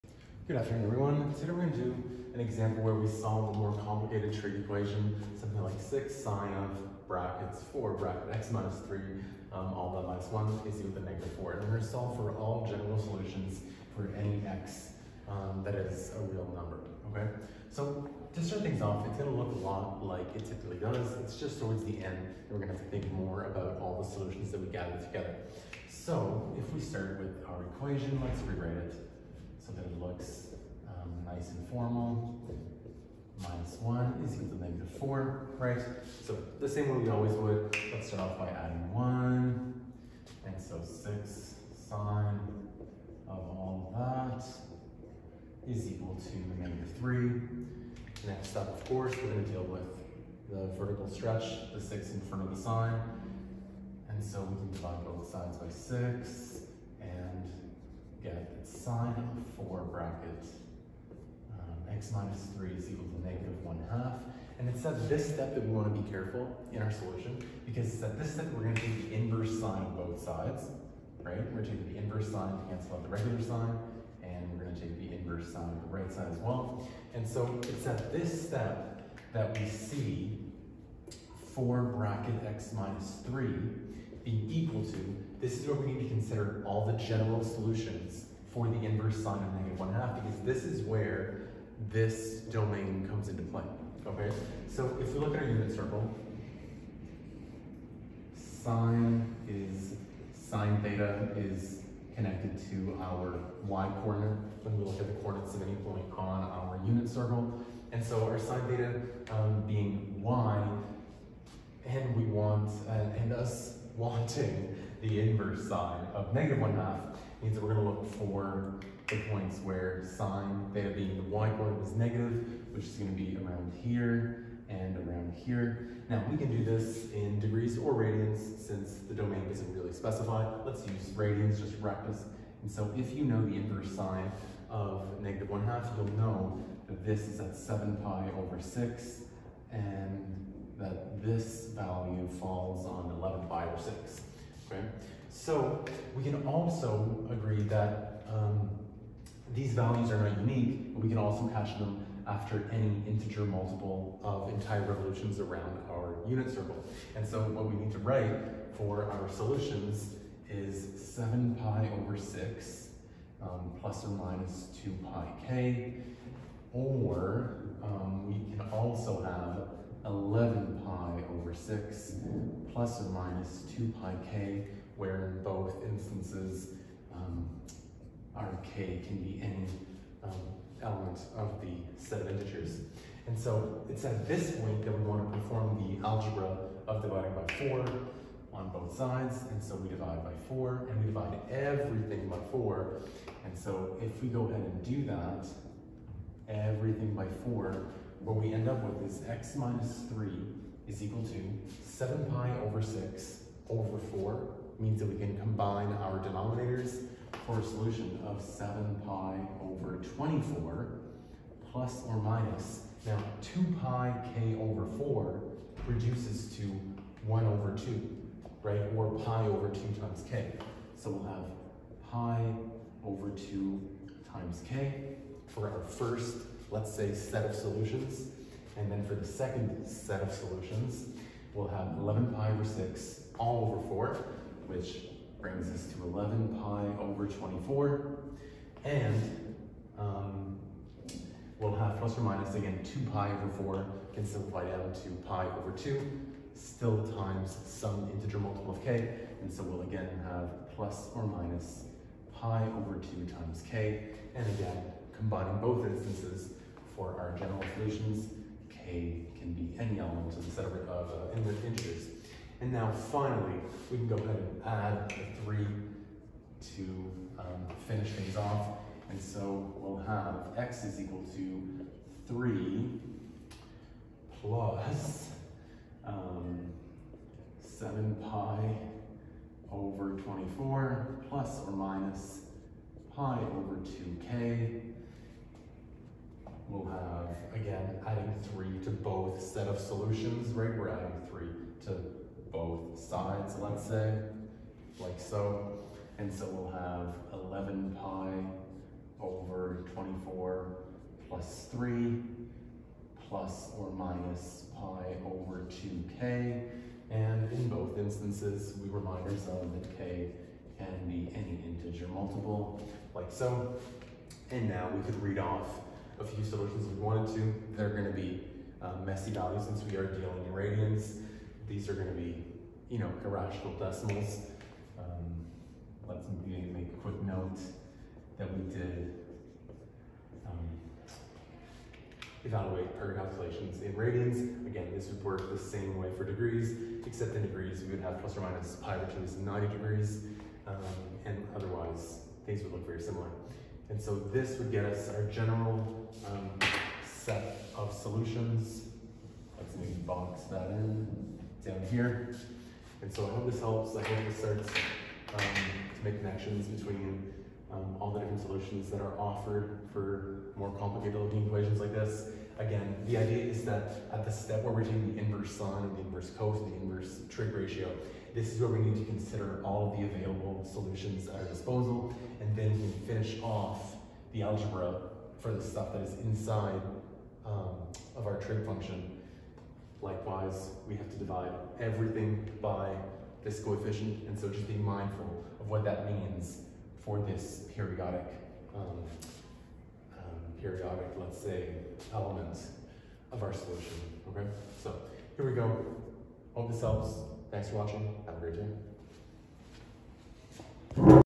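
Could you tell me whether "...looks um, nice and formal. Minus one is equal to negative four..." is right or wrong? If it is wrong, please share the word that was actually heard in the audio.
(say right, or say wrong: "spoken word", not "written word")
right.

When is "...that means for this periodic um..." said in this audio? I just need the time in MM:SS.
06:25.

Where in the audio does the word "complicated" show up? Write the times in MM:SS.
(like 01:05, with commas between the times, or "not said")
00:03, 06:00.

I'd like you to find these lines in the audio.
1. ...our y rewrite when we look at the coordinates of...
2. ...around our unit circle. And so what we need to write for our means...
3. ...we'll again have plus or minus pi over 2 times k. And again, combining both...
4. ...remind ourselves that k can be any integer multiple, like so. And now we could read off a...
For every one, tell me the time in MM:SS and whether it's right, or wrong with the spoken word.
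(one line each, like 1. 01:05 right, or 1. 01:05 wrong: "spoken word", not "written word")
1. 01:43 wrong: "coordinate", not "rewrite"
2. 02:35 wrong: "solutions", not "means"
3. 04:09 right
4. 05:08 right.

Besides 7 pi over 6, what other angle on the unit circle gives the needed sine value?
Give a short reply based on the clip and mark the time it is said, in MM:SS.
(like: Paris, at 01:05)
11 pi/6, at 02:23.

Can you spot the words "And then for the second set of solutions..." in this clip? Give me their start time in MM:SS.
03:48.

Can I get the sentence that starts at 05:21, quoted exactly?
These are going to be, you know, irrational decimals.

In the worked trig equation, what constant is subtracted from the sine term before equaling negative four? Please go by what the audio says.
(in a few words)
1.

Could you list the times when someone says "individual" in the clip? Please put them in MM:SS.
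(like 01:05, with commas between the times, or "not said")
not said.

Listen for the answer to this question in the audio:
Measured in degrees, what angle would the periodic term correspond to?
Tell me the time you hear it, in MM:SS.
05:39.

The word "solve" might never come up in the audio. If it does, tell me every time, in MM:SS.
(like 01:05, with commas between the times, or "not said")
00:03, 00:11.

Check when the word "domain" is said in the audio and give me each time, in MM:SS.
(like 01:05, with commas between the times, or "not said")
01:32, 02:09.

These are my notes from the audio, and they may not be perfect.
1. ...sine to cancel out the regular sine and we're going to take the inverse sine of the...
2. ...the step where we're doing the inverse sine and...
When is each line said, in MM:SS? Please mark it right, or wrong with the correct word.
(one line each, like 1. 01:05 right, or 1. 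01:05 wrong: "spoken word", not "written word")
1. 01:12 right
2. 06:04 right.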